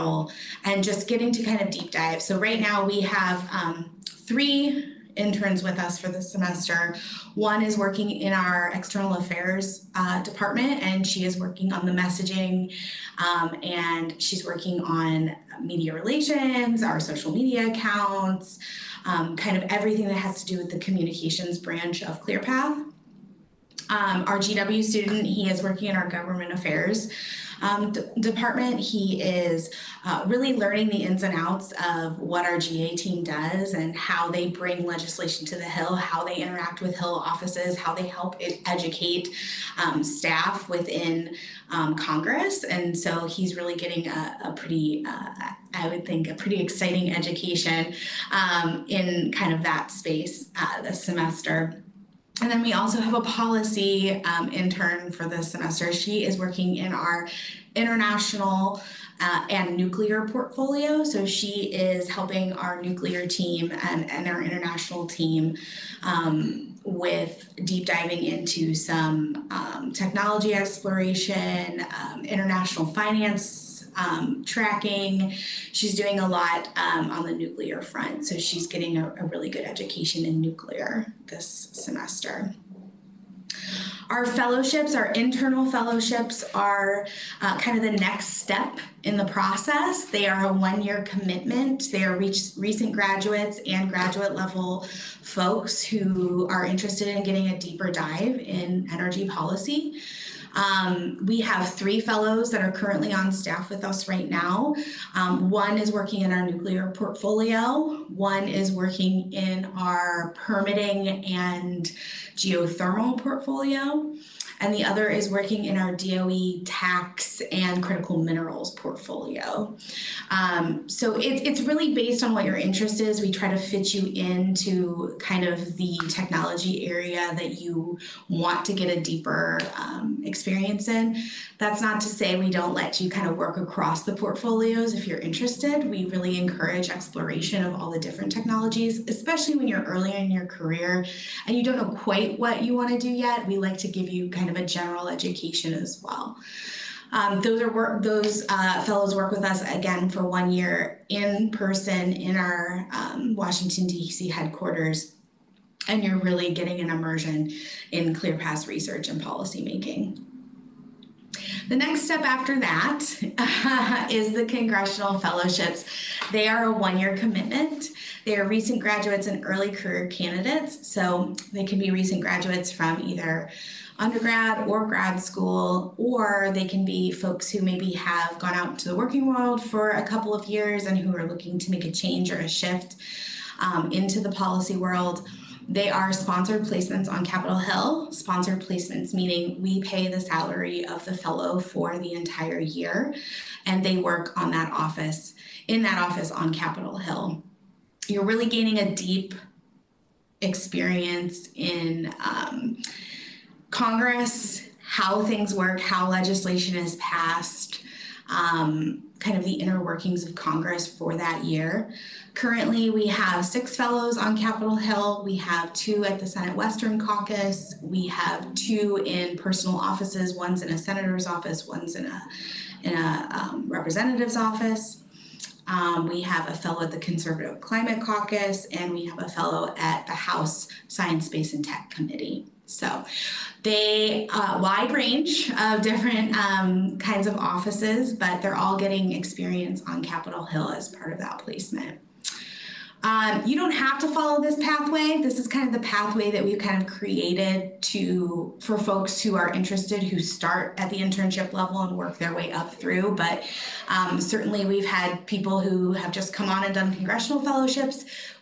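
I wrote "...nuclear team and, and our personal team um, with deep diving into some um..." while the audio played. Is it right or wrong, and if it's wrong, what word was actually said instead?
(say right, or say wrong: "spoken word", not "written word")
wrong: "international", not "personal".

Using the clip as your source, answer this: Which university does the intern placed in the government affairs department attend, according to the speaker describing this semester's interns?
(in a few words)
GW.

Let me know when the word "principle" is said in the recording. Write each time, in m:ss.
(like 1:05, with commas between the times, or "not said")
not said.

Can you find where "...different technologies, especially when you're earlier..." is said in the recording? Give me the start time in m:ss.
2:17.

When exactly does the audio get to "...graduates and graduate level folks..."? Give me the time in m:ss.
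1:32.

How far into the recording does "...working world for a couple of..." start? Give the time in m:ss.
2:58.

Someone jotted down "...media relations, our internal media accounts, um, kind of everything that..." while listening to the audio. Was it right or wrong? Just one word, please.
wrong.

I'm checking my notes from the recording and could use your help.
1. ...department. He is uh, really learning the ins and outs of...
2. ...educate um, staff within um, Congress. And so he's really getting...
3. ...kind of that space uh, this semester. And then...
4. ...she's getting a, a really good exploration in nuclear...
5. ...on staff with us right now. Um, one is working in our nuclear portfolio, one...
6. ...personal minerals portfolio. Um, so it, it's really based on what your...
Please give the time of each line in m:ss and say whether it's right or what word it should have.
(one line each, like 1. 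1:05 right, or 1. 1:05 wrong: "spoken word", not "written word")
1. 0:28 right
2. 0:38 right
3. 0:49 right
4. 1:18 wrong: "education", not "exploration"
5. 1:43 right
6. 1:57 wrong: "critical", not "personal".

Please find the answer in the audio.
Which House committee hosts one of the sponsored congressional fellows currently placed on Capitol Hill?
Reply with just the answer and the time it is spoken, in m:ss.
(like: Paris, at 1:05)
House Science, Space, and Tech Committee, at 3:50.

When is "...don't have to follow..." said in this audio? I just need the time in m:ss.
4:03.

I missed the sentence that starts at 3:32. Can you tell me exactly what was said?
Currently, we have six fellows on Capitol Hill.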